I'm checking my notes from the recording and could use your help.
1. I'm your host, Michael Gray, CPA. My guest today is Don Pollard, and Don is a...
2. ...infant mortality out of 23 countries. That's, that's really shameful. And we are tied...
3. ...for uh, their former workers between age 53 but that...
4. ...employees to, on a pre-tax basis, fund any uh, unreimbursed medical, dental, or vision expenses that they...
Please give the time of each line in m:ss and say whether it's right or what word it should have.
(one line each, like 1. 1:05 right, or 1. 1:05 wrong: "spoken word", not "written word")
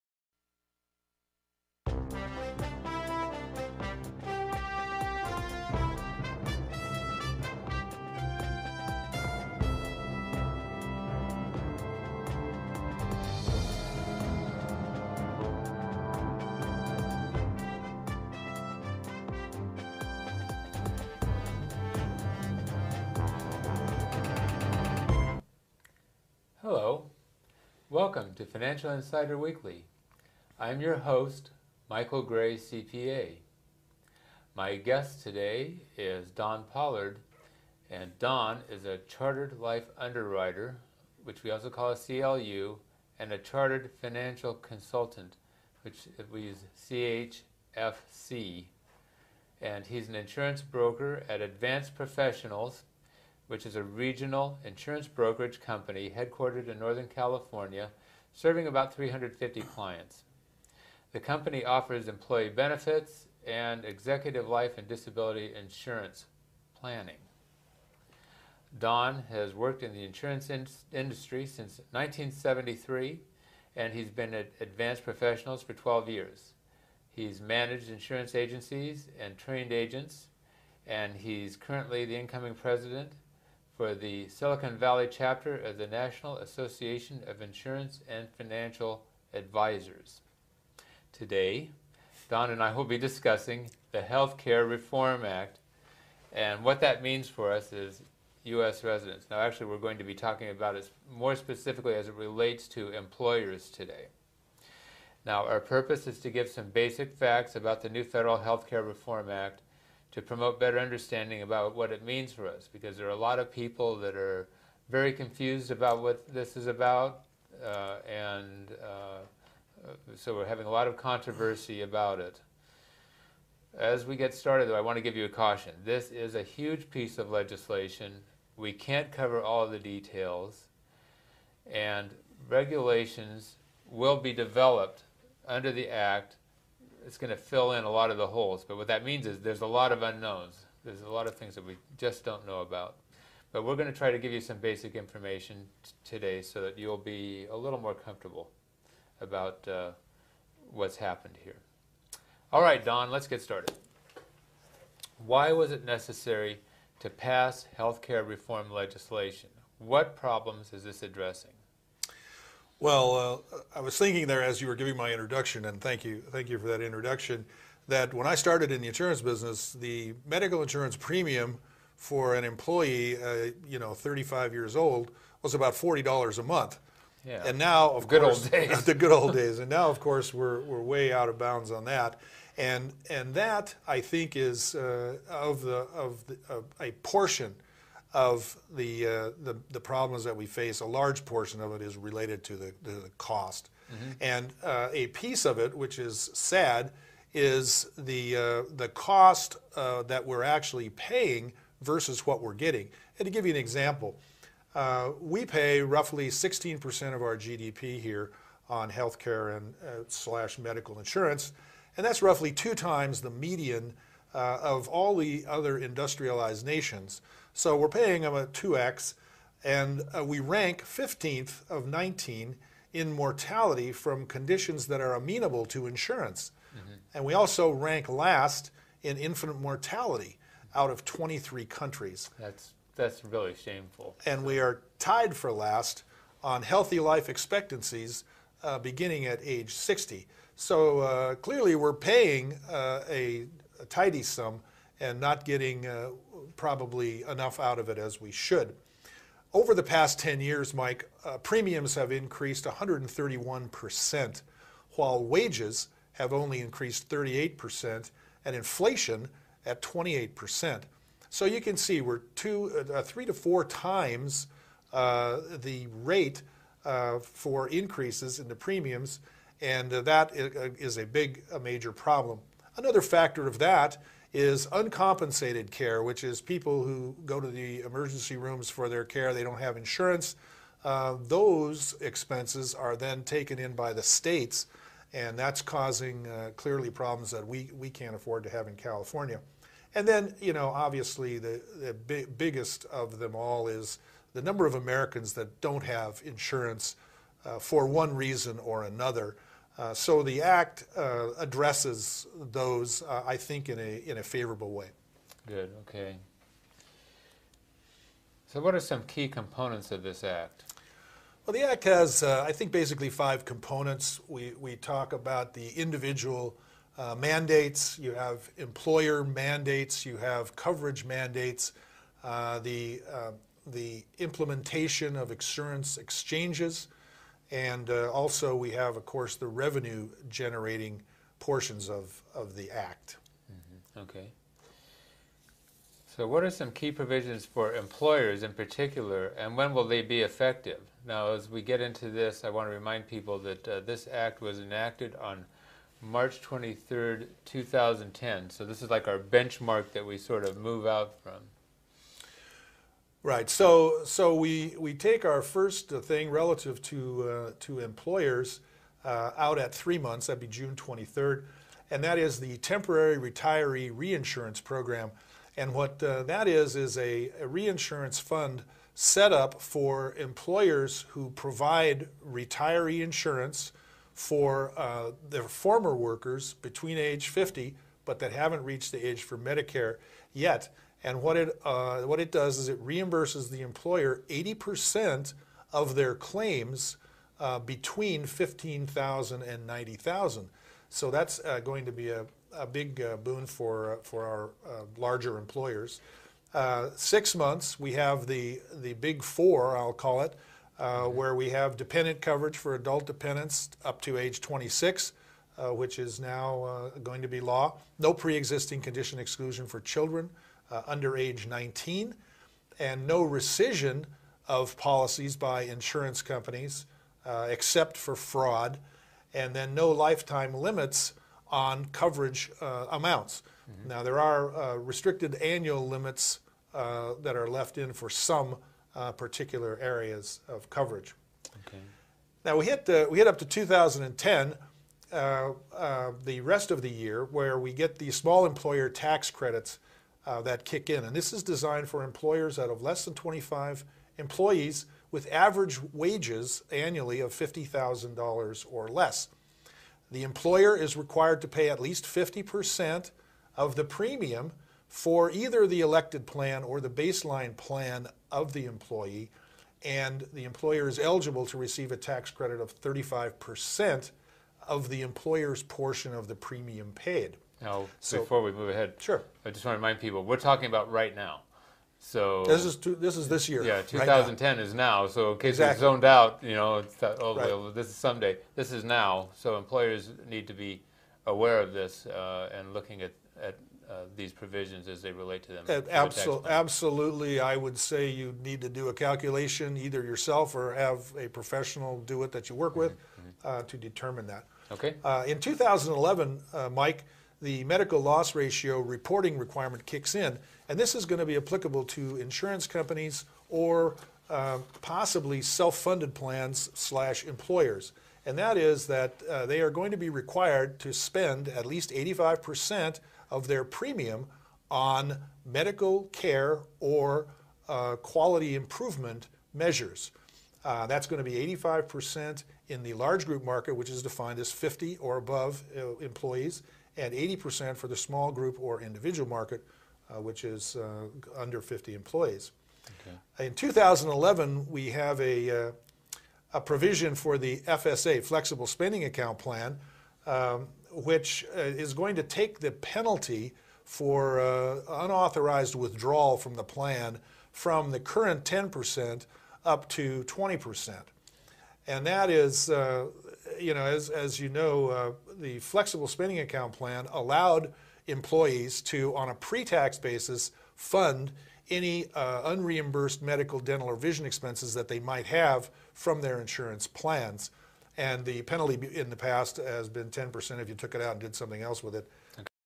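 1. 0:30 right
2. 3:49 right
3. 6:14 wrong: "50", not "53"
4. 9:18 right.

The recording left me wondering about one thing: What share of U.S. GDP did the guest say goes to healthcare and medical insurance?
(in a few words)
16%.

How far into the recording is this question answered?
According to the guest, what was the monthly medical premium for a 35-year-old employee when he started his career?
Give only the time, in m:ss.
2:55.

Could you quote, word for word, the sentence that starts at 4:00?
So uh, clearly, we're paying uh, a tidy sum and not getting uh, probably enough out of it as we should.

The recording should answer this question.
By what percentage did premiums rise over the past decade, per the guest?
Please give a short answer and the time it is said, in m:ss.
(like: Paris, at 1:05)
131%, at 4:12.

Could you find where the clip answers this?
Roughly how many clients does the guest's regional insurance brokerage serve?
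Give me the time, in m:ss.
0:58.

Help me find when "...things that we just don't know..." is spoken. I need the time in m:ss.
2:21.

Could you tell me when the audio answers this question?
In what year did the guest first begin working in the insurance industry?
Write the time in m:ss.
1:11.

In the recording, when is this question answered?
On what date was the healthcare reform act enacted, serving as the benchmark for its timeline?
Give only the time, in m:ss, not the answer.
5:46.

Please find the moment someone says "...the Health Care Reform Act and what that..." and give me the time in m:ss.
1:33.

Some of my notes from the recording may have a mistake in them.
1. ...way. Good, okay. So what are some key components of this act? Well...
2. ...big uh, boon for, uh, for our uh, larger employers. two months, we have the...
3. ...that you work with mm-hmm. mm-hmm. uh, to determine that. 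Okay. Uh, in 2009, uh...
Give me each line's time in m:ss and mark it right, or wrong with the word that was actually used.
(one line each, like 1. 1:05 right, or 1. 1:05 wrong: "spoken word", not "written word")
1. 5:04 right
2. 6:32 wrong: "six", not "two"
3. 8:12 wrong: "2011", not "2009".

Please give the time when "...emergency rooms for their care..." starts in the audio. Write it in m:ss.
4:37.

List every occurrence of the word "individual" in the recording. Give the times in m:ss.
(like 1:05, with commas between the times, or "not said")
5:15, 8:48.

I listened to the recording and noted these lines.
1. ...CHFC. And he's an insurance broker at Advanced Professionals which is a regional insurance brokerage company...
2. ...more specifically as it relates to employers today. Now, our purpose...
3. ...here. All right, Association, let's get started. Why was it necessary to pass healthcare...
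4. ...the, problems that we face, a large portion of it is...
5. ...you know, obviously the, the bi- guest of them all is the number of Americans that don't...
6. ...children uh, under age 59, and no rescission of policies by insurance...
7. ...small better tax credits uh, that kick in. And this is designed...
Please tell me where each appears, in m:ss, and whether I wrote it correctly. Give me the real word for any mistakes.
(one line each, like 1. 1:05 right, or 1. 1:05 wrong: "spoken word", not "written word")
1. 0:46 right
2. 1:41 right
3. 2:31 wrong: "Don", not "Association"
4. 3:09 right
5. 4:50 wrong: "biggest", not "guest"
6. 6:49 wrong: "19", not "59"
7. 7:18 wrong: "employer", not "better".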